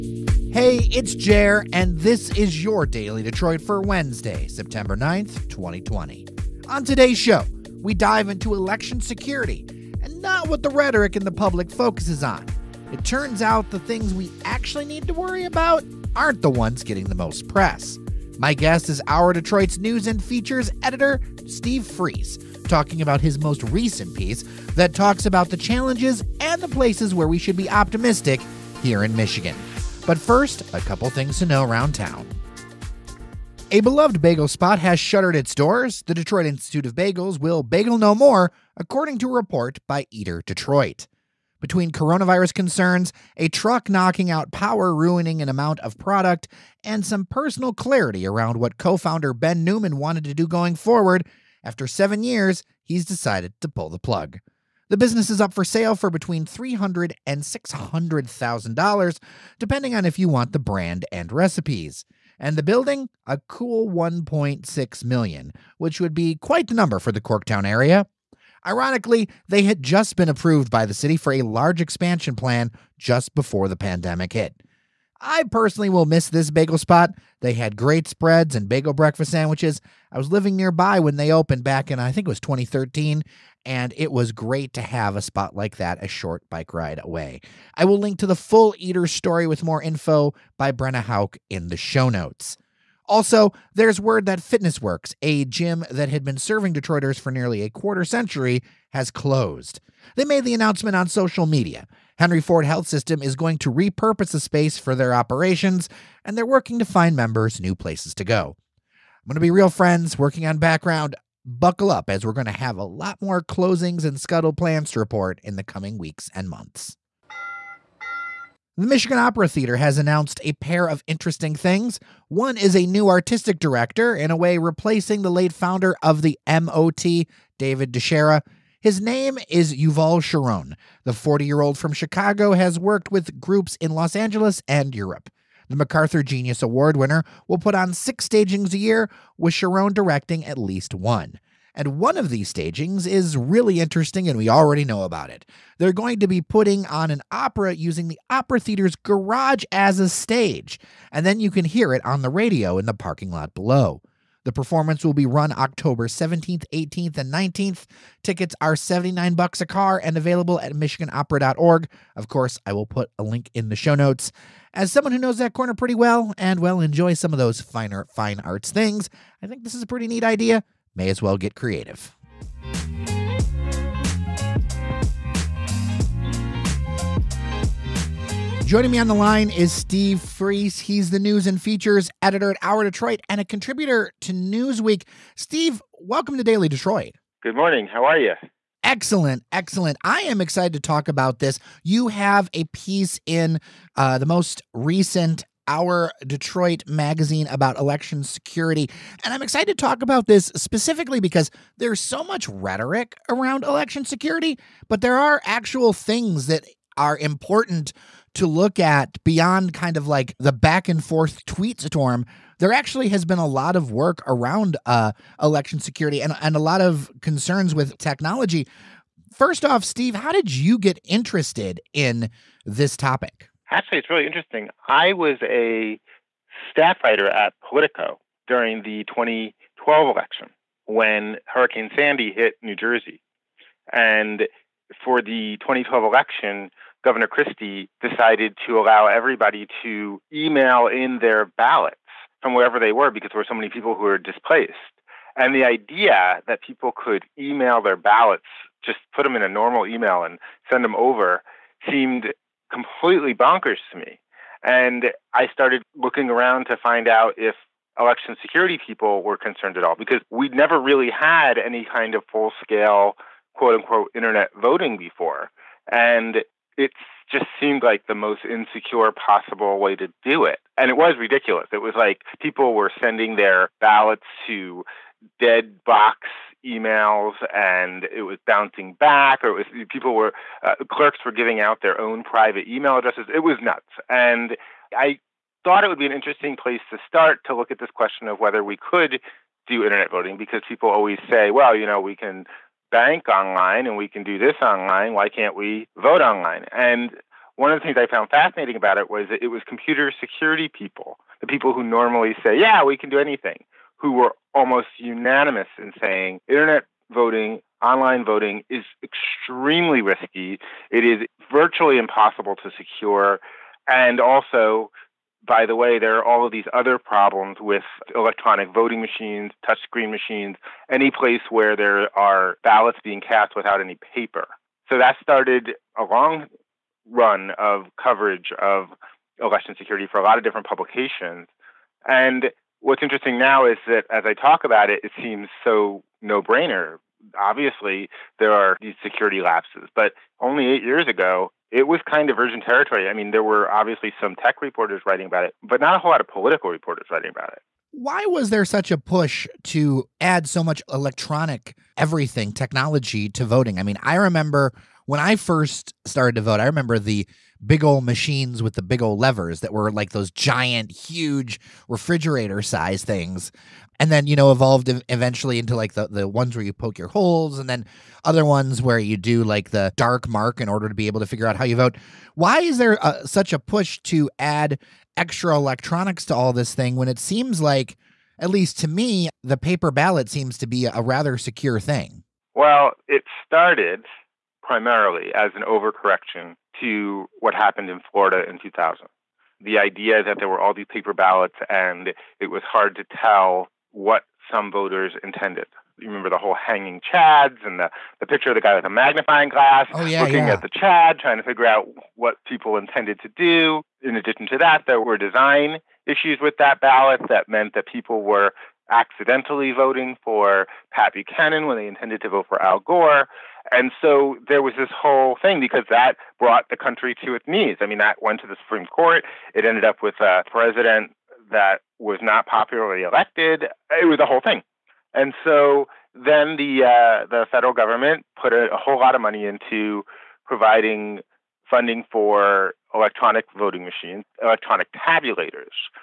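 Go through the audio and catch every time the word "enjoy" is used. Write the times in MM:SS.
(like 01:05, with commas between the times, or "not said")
02:46.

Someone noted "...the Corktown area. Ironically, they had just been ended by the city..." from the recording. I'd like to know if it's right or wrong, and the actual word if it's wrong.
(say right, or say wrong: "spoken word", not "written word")
wrong: "approved", not "ended".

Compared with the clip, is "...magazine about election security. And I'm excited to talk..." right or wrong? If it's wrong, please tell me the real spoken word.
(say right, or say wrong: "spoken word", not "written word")
right.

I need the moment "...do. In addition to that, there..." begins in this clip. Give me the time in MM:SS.
06:43.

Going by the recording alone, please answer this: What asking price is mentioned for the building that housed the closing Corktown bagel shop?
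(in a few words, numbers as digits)
$1.6 million.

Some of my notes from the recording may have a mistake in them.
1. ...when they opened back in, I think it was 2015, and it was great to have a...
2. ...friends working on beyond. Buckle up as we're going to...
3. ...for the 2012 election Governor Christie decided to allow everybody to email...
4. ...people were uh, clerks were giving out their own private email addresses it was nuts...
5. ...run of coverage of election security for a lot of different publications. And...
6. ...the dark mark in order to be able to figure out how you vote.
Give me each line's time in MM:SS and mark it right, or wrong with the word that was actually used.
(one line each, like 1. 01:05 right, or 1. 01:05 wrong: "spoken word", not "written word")
1. 01:20 wrong: "2013", not "2015"
2. 01:49 wrong: "background", not "beyond"
3. 03:55 right
4. 04:39 right
5. 05:27 right
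6. 06:09 right.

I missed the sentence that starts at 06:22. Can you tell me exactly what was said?
Well, it started primarily as an overcorrection to what happened in Florida in 2000.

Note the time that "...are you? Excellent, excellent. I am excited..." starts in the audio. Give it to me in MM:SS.
03:08.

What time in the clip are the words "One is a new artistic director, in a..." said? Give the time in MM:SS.
02:02.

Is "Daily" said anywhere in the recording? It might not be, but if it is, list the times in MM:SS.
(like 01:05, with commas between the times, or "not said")
00:02, 03:06.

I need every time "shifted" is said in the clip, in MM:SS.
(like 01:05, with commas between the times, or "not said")
not said.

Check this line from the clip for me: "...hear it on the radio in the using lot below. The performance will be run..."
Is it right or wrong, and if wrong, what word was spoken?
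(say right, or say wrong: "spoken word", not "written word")
wrong: "parking", not "using".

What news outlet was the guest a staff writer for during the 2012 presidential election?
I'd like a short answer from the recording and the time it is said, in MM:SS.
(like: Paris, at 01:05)
Politico, at 03:47.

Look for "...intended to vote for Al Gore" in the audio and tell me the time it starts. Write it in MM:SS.
06:51.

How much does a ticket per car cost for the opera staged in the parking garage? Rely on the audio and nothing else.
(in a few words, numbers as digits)
$79.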